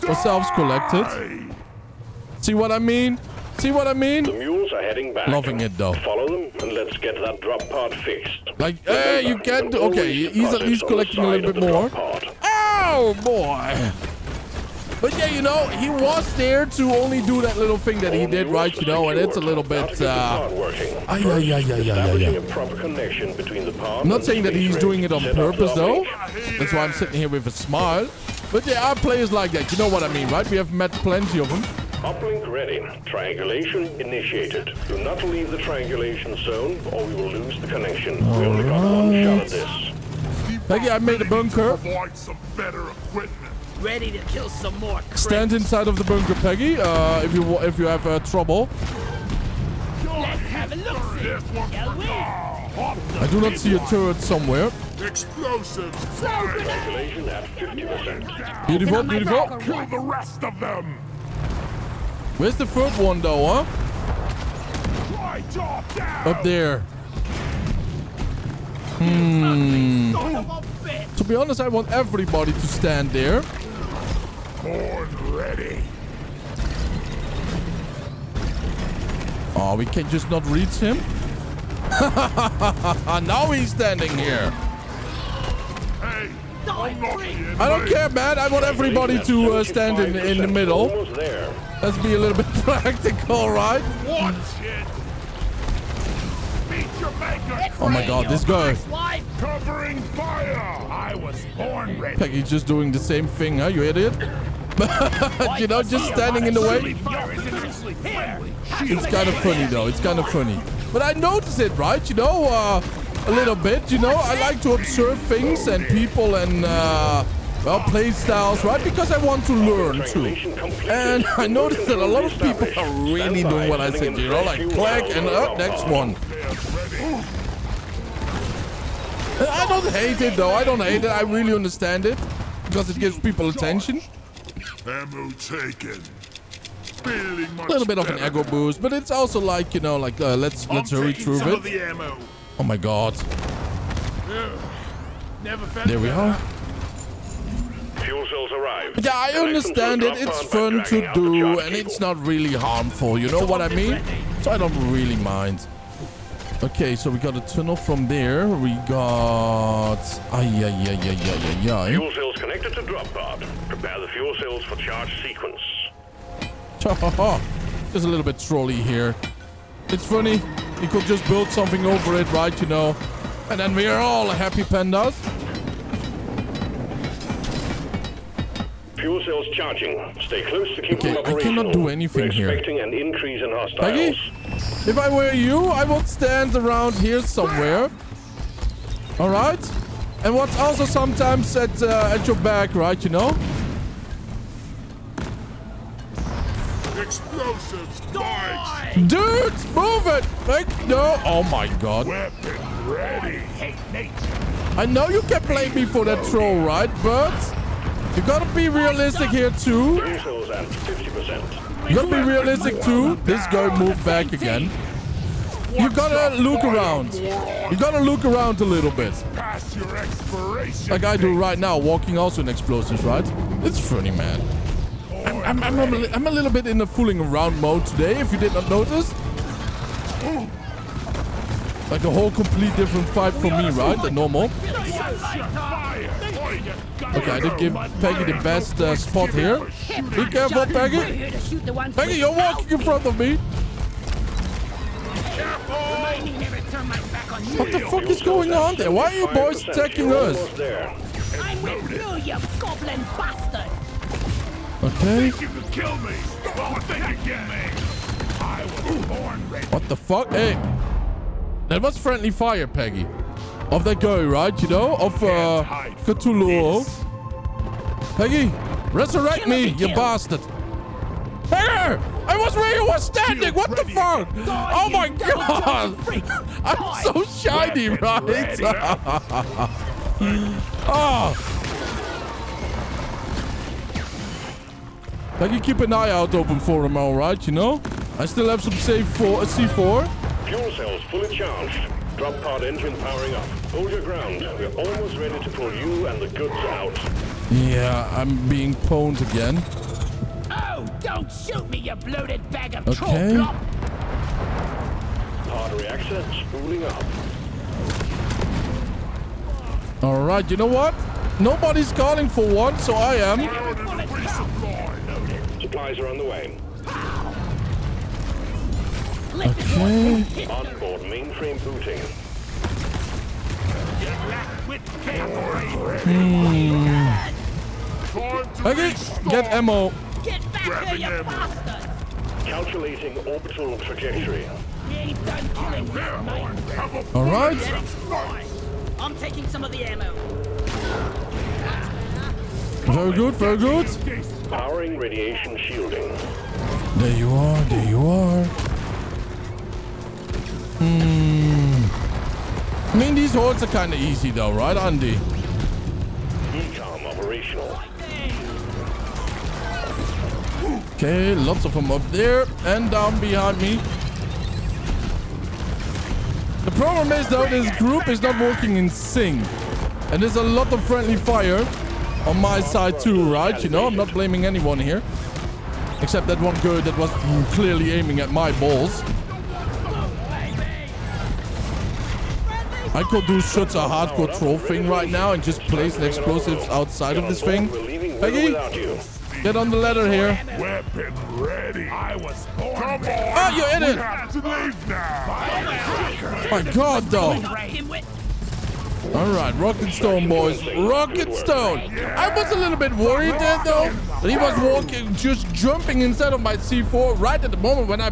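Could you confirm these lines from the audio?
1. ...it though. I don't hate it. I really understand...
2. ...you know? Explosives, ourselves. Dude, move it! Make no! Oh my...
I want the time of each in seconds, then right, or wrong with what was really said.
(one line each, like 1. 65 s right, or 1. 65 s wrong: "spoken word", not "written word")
1. 130 s right
2. 193 s wrong: "spikes", not "ourselves".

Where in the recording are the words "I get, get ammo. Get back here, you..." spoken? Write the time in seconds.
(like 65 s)
328 s.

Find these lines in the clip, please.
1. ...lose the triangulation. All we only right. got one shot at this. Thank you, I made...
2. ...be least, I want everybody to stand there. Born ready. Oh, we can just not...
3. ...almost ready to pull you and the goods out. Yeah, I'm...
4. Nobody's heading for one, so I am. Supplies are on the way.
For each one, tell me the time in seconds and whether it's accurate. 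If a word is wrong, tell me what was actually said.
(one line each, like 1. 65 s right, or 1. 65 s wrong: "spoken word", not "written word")
1. 37 s wrong: "connection", not "triangulation"
2. 71 s wrong: "honest", not "least"
3. 294 s right
4. 311 s wrong: "calling", not "heading".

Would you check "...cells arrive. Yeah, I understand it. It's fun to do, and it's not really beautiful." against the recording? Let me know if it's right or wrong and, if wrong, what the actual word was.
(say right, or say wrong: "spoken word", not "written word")
wrong: "harmful", not "beautiful".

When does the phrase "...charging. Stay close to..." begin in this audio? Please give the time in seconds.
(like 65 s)
179 s.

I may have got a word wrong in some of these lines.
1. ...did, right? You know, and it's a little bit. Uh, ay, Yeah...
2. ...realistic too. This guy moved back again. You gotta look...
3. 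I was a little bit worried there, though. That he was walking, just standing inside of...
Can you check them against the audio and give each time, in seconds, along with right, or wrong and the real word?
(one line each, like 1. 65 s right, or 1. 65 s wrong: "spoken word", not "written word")
1. 18 s right
2. 212 s right
3. 401 s wrong: "jumping", not "standing".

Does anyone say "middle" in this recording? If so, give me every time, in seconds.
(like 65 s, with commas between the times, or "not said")
90 s.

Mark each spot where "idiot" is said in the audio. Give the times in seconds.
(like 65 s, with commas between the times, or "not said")
103 s, 393 s.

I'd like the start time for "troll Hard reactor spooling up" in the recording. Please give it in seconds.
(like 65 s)
303 s.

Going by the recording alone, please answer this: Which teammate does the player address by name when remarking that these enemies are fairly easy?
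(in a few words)
Andy.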